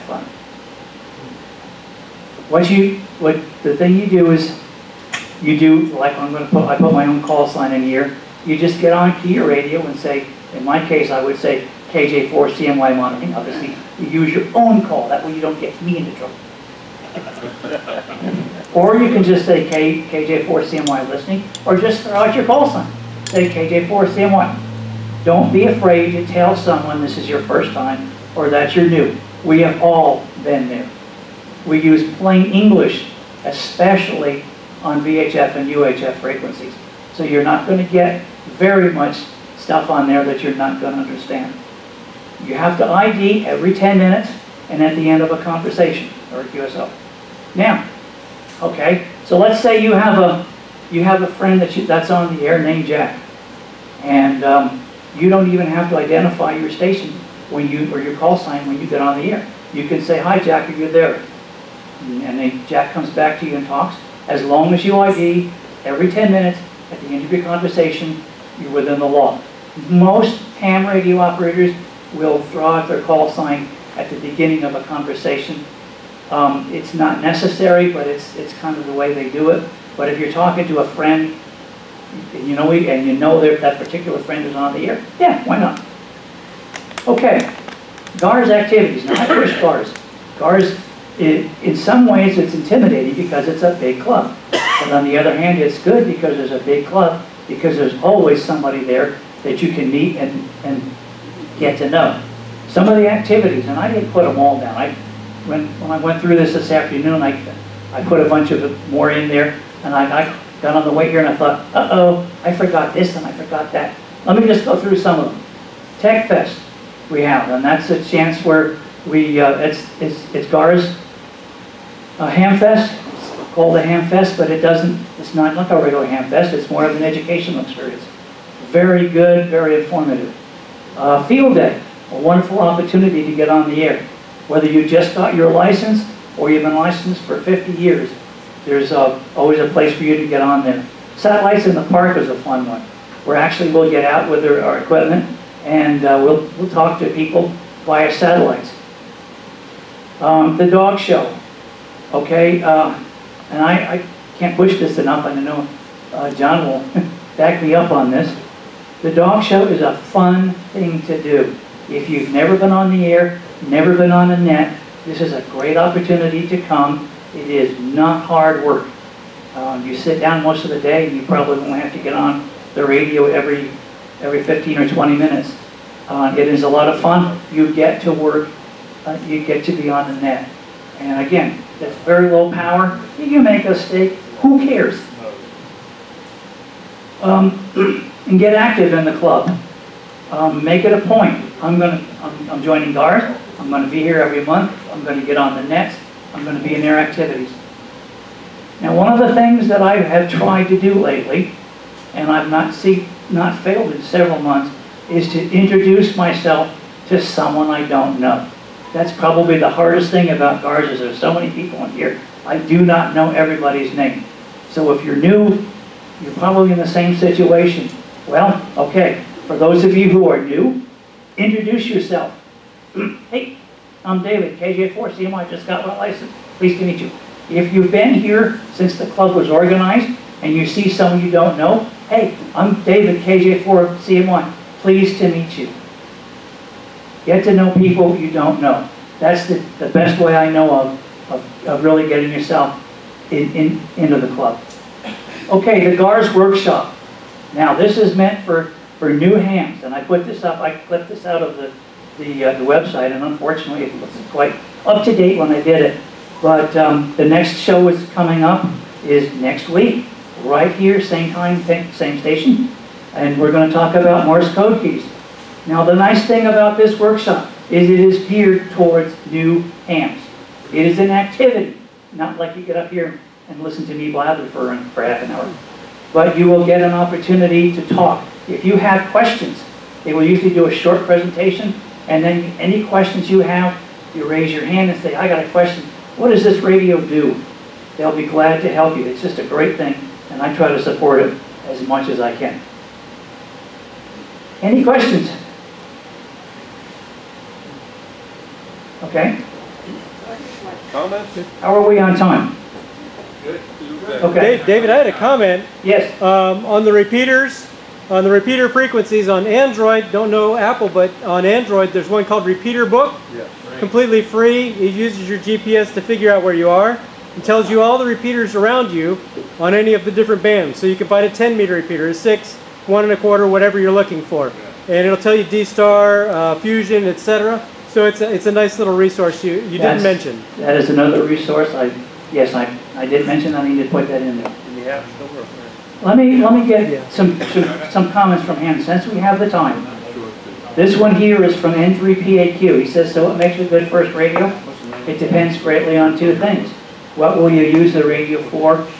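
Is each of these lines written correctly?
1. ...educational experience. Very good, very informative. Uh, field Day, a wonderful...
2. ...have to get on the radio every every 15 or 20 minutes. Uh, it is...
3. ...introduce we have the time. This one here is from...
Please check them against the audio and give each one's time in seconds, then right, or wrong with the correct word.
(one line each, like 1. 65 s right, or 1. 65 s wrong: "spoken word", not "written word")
1. 127 s right
2. 171 s right
3. 338 s wrong: "since", not "introduce".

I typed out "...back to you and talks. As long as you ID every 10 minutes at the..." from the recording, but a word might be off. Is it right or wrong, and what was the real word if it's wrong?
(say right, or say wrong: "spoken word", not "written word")
right.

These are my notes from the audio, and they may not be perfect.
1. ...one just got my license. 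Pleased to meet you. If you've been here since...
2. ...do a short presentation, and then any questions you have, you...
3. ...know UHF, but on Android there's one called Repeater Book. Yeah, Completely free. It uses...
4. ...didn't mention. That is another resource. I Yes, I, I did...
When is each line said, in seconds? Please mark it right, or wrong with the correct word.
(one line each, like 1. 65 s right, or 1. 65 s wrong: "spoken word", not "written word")
1. 225 s right
2. 280 s right
3. 310 s wrong: "Apple", not "UHF"
4. 329 s right.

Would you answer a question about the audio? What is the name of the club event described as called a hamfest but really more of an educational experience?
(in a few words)
Tech Fest.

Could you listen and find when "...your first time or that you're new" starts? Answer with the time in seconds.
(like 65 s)
27 s.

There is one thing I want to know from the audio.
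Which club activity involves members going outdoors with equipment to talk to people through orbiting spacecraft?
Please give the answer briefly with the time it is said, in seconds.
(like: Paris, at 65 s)
Satellites in the Park, at 141 s.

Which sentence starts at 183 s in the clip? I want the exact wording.
You make a mistake, who cares?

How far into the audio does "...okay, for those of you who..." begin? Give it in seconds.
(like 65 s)
218 s.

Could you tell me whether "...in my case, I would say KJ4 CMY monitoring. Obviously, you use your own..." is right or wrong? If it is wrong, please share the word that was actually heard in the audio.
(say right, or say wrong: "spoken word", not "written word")
right.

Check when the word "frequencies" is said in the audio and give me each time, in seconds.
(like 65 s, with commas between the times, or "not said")
36 s, 308 s.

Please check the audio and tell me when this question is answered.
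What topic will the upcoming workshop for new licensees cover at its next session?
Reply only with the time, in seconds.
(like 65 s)
264 s.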